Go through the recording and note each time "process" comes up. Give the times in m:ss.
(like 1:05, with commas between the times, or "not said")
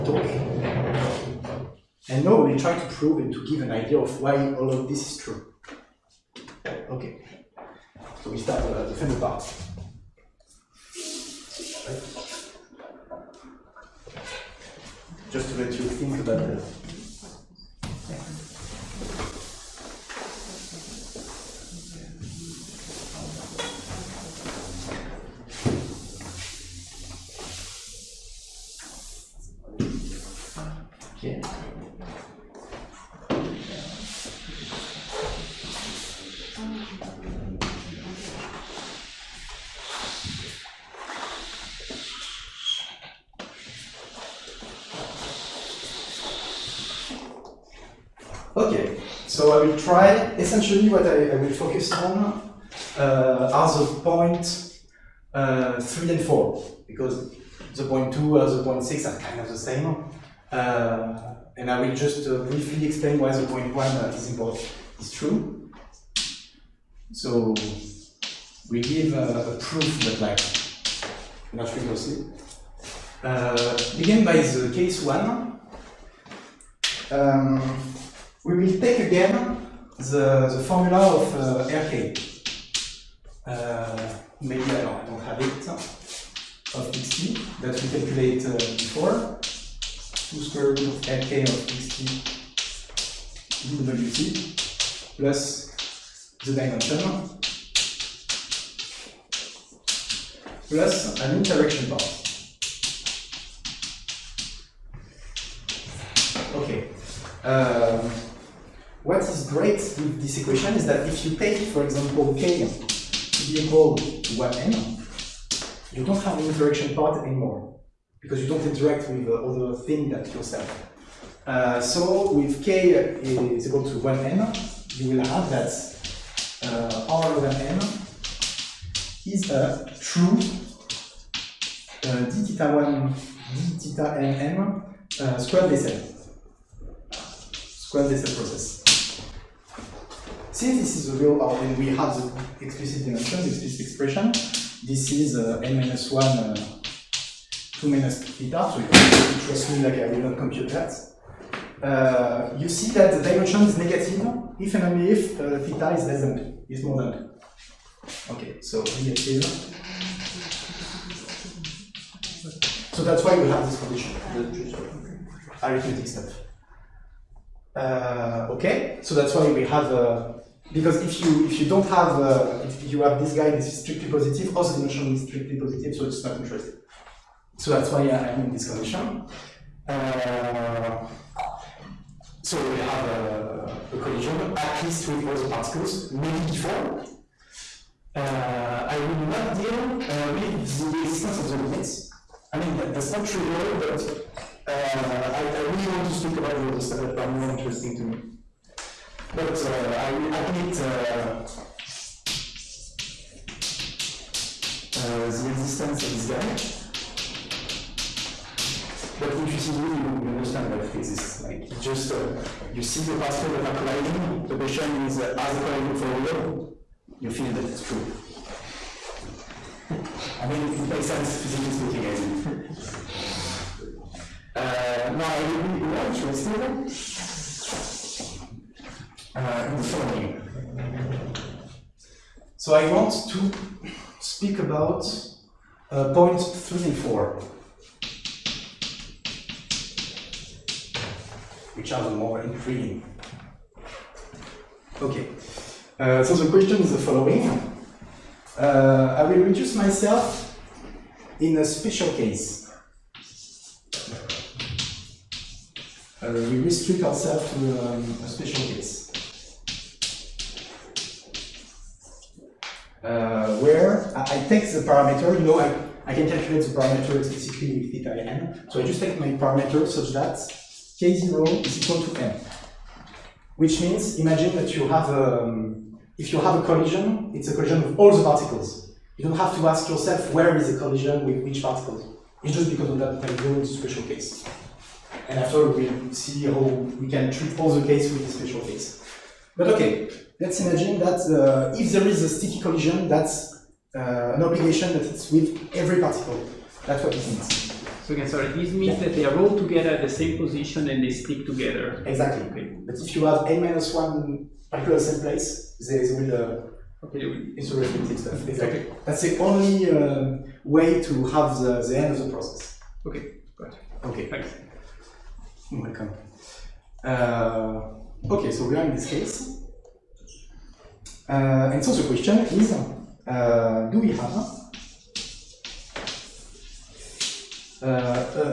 2:18, 5:12.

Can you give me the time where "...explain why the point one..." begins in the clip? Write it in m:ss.
1:02.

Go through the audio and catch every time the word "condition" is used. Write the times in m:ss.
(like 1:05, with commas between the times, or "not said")
2:43, 2:58.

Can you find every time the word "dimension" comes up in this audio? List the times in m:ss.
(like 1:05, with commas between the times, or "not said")
1:36, 2:33.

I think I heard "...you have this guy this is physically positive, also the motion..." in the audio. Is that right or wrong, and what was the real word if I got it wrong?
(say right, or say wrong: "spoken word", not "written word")
wrong: "strictly", not "physically".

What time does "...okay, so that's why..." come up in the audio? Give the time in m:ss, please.
2:48.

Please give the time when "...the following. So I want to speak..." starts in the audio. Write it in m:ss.
3:49.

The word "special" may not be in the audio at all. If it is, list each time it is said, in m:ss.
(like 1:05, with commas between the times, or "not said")
4:11, 4:18, 4:43, 4:48.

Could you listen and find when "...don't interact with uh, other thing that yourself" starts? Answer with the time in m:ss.
1:58.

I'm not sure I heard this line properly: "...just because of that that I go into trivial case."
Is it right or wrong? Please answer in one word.
wrong.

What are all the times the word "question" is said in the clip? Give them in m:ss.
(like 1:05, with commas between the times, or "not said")
3:34, 4:06, 5:22.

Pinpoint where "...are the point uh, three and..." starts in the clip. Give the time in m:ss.
0:53.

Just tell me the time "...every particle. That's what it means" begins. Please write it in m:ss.
4:55.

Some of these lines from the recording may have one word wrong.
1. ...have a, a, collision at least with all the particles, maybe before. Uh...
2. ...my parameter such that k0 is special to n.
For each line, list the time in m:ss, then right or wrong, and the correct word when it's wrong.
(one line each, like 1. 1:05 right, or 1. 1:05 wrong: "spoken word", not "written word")
1. 3:02 right
2. 4:29 wrong: "equal", not "special".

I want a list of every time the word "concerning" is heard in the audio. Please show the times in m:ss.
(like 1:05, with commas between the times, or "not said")
not said.